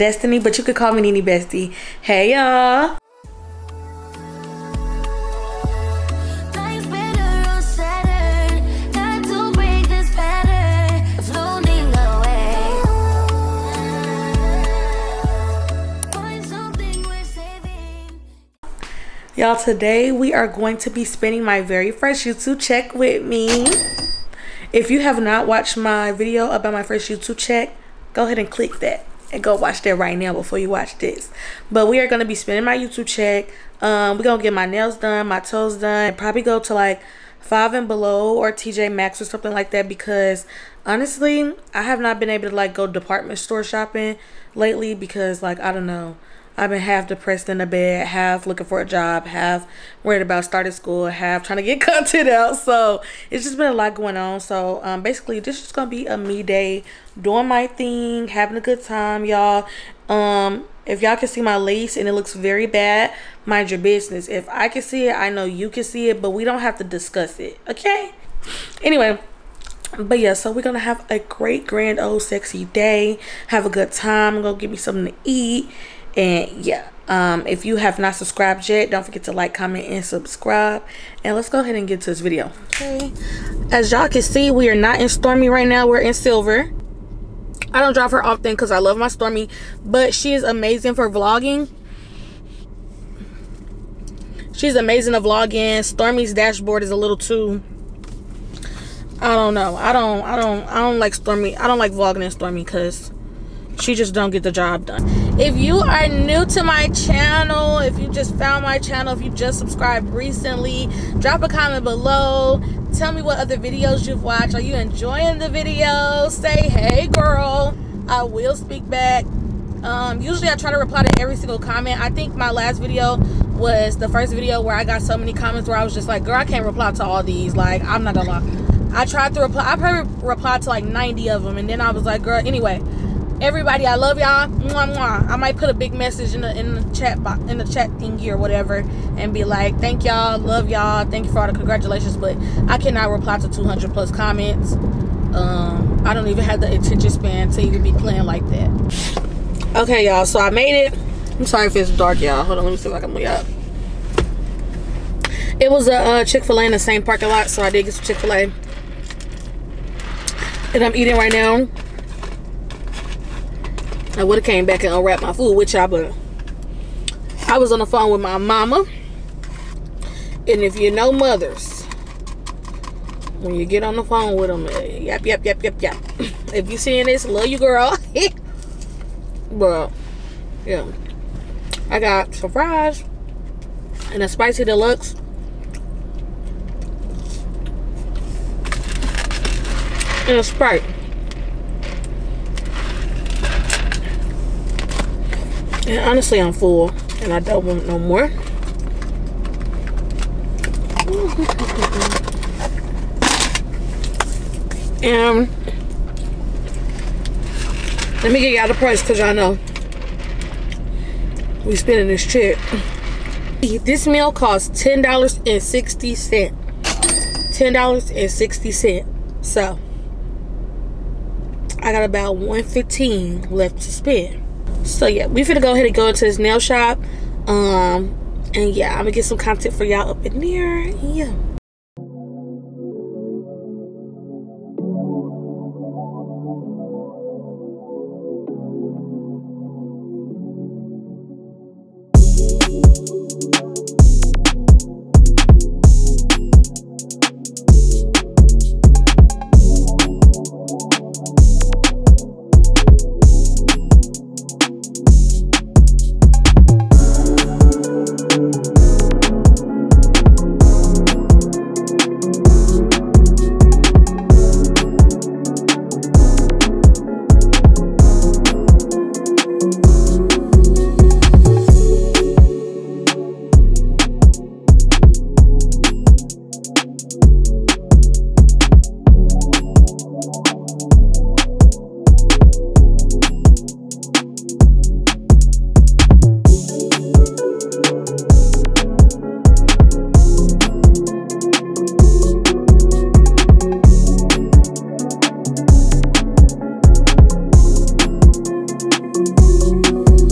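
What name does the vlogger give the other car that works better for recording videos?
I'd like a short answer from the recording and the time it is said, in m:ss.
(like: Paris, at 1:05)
Silver, at 1:26.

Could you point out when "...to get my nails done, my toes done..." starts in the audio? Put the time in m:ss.
0:34.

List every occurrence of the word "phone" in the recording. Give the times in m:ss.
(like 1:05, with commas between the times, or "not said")
2:47, 2:54.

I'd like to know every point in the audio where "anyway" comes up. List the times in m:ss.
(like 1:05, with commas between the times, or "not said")
1:08, 2:12.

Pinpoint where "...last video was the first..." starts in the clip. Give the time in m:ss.
2:02.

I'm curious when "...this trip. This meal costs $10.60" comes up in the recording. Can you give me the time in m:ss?
3:32.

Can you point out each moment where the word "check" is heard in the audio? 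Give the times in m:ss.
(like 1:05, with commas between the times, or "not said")
0:22, 0:27, 0:33.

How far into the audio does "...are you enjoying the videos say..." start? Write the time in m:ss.
1:54.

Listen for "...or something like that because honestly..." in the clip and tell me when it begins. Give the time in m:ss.
0:39.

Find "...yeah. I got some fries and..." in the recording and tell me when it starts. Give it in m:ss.
3:00.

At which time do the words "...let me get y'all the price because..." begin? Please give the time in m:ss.
3:28.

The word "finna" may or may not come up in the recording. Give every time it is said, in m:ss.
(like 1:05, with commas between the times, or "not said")
3:45.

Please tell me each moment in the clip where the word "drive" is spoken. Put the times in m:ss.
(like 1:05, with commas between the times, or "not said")
1:27.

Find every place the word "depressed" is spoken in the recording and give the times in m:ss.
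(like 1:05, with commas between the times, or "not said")
0:47.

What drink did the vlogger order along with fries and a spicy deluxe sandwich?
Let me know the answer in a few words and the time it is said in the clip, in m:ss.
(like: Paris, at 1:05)
Sprite, at 3:10.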